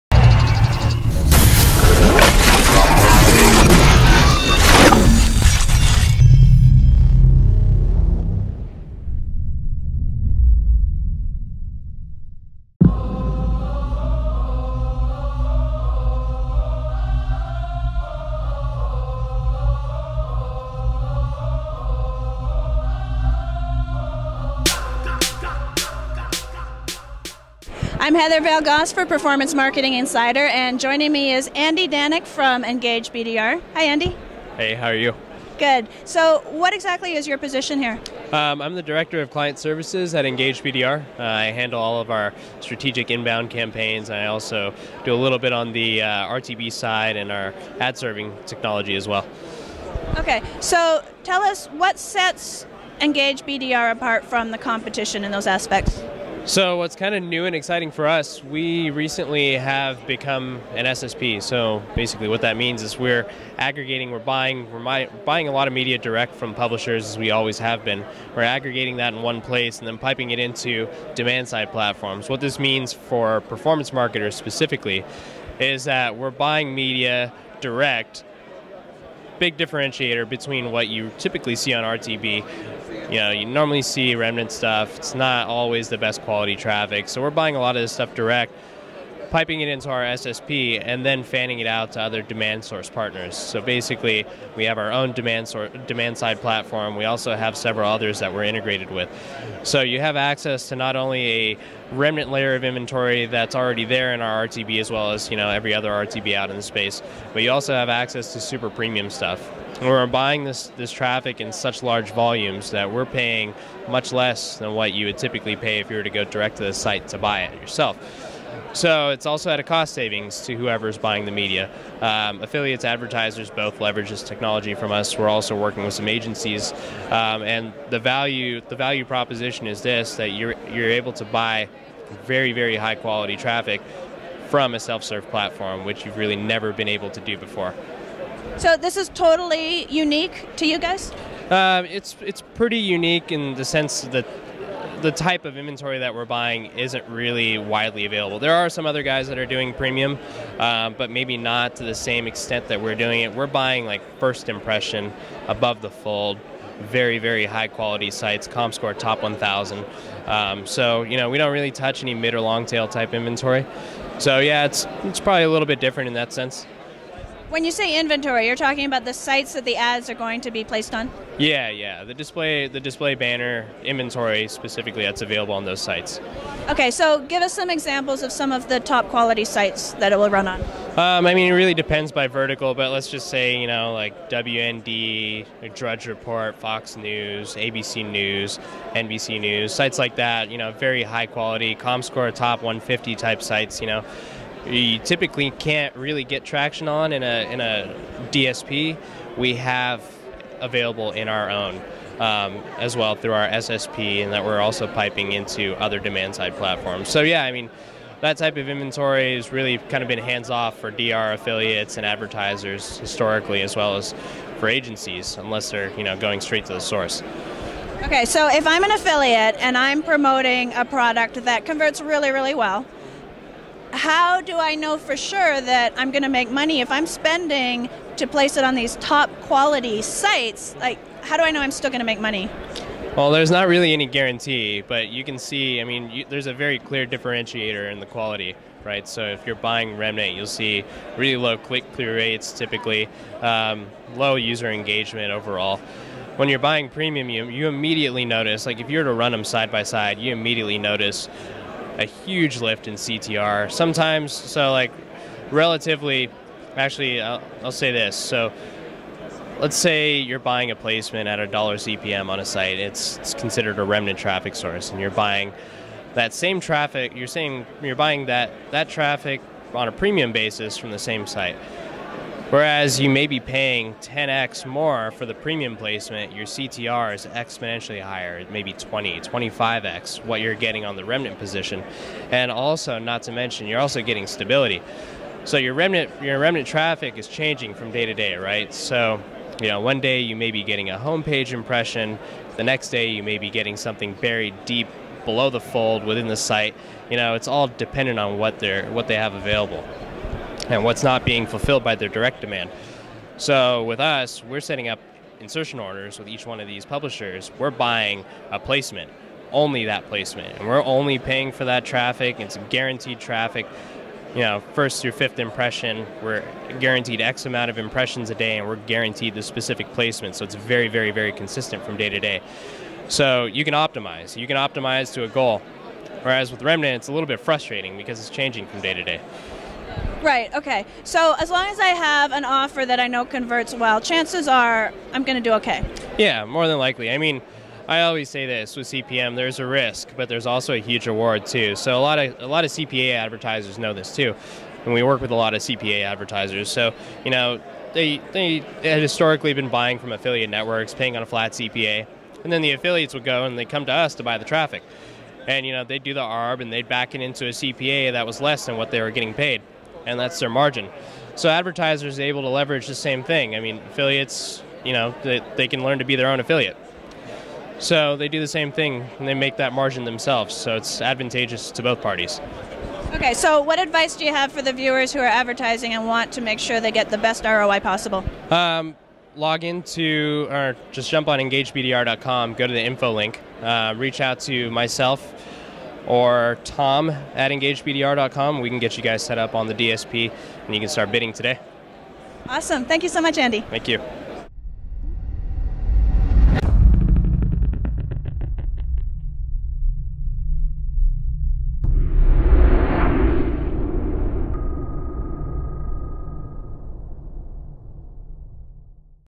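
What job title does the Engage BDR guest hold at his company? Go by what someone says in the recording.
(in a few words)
Director of Client Services.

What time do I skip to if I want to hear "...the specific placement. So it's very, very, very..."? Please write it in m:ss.
5:19.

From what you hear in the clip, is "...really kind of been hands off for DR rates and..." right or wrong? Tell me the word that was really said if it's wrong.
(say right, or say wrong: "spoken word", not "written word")
wrong: "affiliates", not "rates".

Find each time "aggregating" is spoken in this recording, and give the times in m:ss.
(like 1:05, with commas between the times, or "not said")
1:03, 1:08.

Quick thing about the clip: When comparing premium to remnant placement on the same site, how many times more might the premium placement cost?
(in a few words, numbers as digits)
10x.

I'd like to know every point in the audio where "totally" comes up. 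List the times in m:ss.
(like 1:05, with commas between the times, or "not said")
2:19.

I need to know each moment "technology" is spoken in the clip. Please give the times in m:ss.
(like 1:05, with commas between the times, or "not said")
0:48, 2:04.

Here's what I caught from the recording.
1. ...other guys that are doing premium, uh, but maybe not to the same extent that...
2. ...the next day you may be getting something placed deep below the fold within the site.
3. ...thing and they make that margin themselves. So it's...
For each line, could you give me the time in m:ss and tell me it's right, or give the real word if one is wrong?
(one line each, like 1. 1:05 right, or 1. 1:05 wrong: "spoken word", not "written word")
1. 2:28 right
2. 4:52 wrong: "buried", not "placed"
3. 6:08 right.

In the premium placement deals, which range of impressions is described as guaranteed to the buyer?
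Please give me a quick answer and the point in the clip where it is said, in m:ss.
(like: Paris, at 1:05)
first through fifth impression, at 5:14.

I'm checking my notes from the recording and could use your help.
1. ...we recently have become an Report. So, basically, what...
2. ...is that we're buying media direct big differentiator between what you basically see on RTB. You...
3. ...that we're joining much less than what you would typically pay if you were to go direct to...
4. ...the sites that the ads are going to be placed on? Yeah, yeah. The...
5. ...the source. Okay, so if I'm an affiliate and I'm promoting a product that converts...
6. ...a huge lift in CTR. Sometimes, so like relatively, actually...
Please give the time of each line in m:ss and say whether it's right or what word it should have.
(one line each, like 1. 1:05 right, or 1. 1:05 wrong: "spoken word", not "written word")
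1. 0:58 wrong: "SSP", not "Report"
2. 1:15 wrong: "typically", not "basically"
3. 1:52 wrong: "paying", not "joining"
4. 2:49 right
5. 3:36 right
6. 4:11 right.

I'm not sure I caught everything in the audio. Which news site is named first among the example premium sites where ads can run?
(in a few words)
WND.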